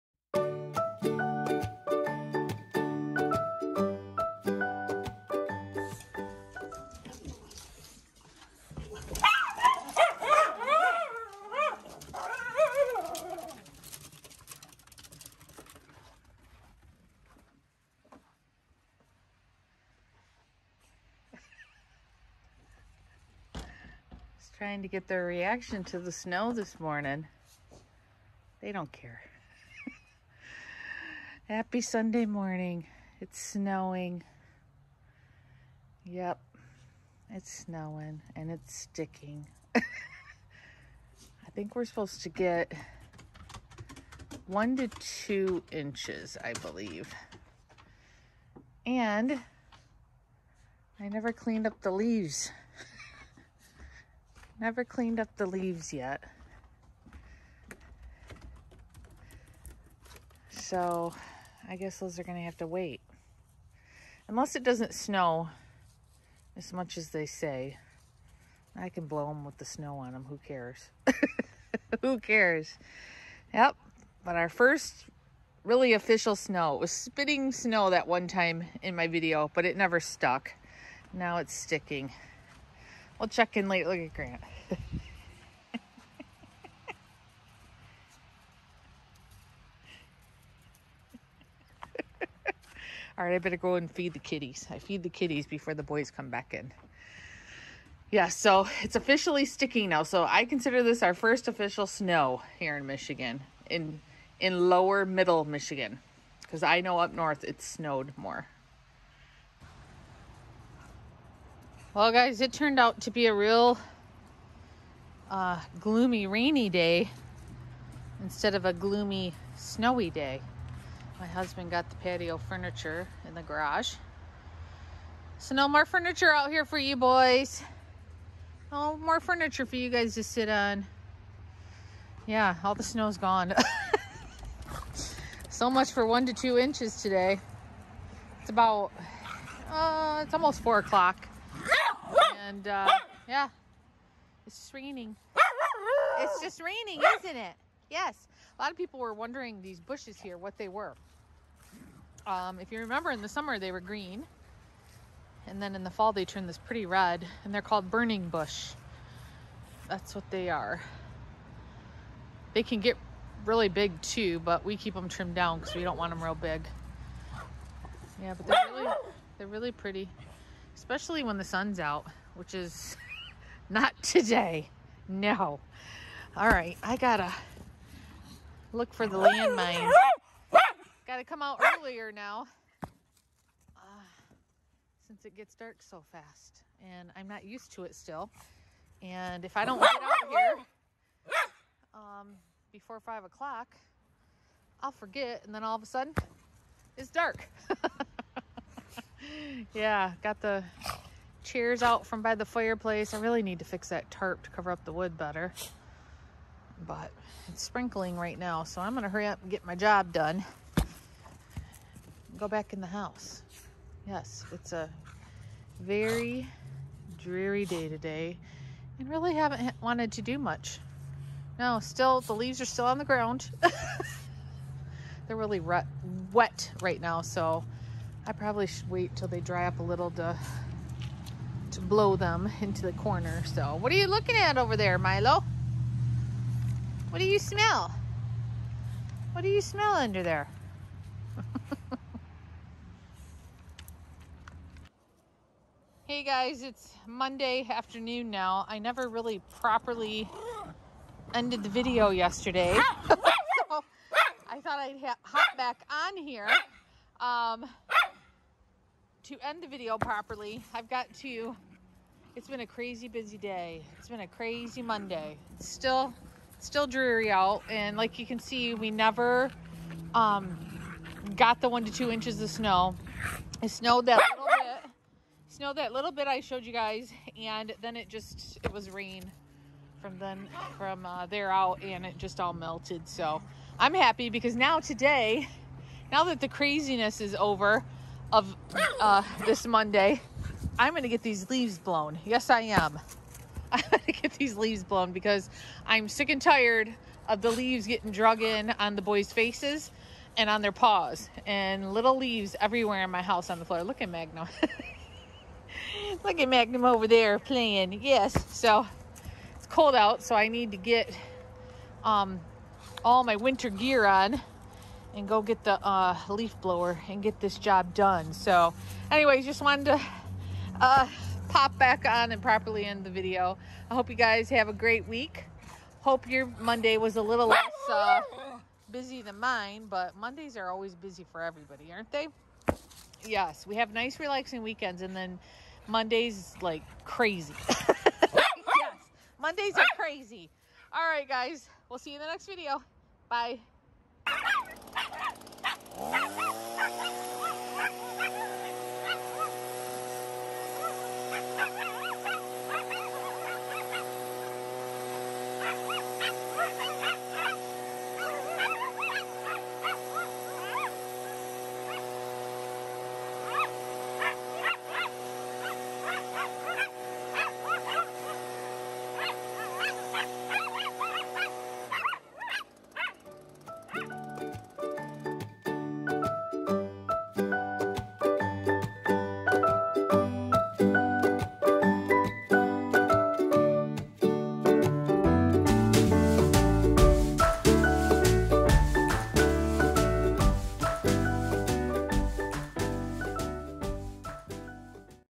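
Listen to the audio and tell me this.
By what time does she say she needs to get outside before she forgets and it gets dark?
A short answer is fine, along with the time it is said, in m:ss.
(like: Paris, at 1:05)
5 o'clock, at 3:12.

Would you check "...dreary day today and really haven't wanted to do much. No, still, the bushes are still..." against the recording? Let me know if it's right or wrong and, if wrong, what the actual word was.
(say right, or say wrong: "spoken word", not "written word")
wrong: "leaves", not "bushes".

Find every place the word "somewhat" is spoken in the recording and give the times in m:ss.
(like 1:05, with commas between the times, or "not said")
not said.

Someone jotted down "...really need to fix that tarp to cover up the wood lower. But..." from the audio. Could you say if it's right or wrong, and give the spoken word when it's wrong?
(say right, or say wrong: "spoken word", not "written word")
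wrong: "better", not "lower".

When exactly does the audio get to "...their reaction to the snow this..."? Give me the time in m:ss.
0:25.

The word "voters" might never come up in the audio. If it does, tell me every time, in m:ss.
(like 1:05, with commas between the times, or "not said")
not said.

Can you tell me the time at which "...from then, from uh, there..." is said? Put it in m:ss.
4:40.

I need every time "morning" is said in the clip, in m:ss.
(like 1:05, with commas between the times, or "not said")
0:26, 0:32.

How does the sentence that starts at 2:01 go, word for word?
My husband got the patio furniture in the garage.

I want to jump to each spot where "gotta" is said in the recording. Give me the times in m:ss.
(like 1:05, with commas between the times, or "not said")
2:56, 3:01.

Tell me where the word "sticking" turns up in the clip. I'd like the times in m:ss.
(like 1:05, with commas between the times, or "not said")
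0:38, 1:21, 1:39.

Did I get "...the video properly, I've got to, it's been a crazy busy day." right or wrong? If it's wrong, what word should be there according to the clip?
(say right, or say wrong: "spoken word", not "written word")
right.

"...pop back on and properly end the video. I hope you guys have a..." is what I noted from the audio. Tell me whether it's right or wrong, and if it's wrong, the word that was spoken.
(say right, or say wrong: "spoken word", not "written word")
right.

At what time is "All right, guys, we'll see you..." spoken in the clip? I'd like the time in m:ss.
5:40.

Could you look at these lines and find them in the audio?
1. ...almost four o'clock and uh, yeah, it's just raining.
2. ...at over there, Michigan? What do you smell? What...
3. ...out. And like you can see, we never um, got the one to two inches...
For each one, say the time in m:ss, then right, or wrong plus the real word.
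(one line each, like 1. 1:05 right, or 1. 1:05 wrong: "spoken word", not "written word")
1. 2:20 right
2. 3:54 wrong: "Milo", not "Michigan"
3. 4:27 right.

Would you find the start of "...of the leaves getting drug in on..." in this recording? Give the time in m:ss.
4:57.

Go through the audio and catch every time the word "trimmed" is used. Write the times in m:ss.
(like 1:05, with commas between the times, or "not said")
2:45.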